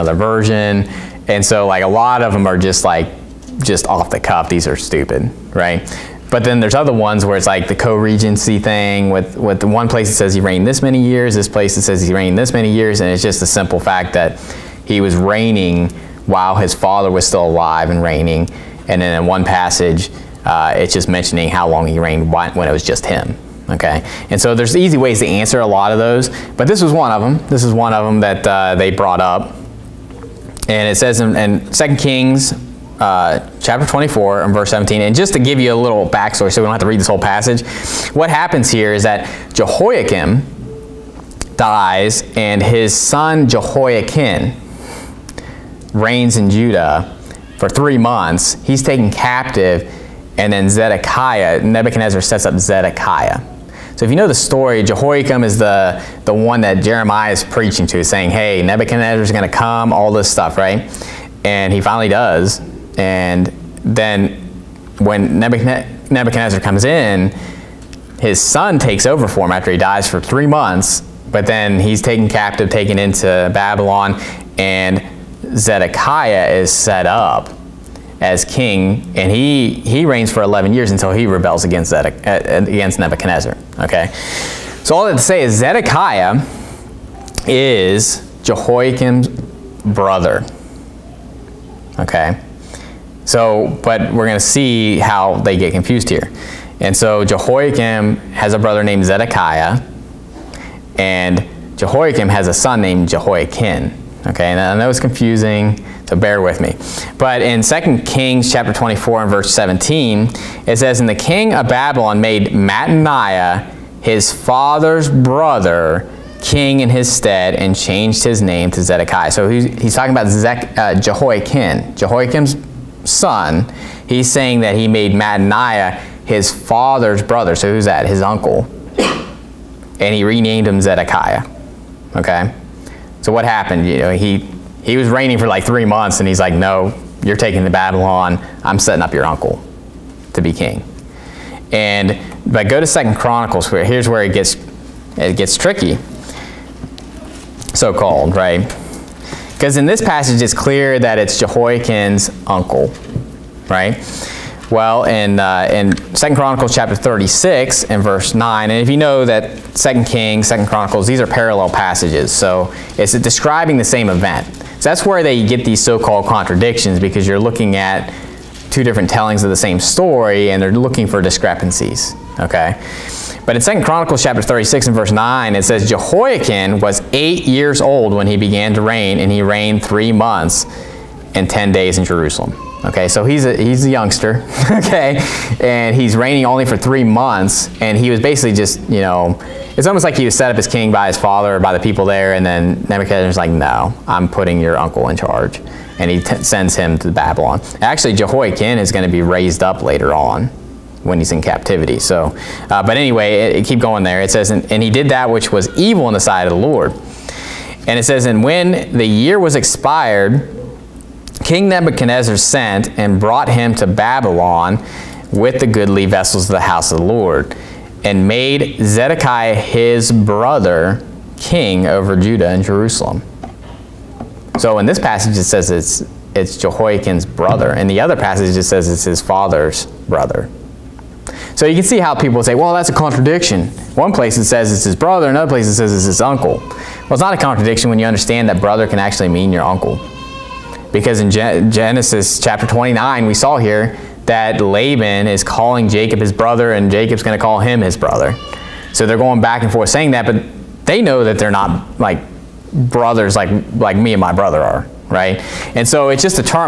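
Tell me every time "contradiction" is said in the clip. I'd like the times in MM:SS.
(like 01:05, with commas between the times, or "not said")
02:46, 03:52, 03:57.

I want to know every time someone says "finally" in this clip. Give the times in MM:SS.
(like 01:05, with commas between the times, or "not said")
01:01.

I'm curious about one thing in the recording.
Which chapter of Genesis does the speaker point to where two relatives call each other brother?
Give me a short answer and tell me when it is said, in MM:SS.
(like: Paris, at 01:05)
29, at 04:01.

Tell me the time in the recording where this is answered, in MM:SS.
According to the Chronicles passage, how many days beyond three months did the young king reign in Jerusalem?
02:59.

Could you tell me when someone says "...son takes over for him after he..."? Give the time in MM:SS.
01:08.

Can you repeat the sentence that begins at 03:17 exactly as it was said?
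Actually, Jehoiakim is going to be raised up later on, when he's in captivity.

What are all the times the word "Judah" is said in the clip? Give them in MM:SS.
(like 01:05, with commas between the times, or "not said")
00:46, 03:42.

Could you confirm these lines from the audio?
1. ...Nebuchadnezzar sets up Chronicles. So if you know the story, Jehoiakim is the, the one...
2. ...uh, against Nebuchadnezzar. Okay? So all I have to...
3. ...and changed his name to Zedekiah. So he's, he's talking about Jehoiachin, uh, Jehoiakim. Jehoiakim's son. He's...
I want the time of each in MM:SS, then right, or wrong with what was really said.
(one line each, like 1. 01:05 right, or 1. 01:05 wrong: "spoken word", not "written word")
1. 00:51 wrong: "Zedekiah", not "Chronicles"
2. 01:22 right
3. 01:57 wrong: "Zech", not "Jehoiachin".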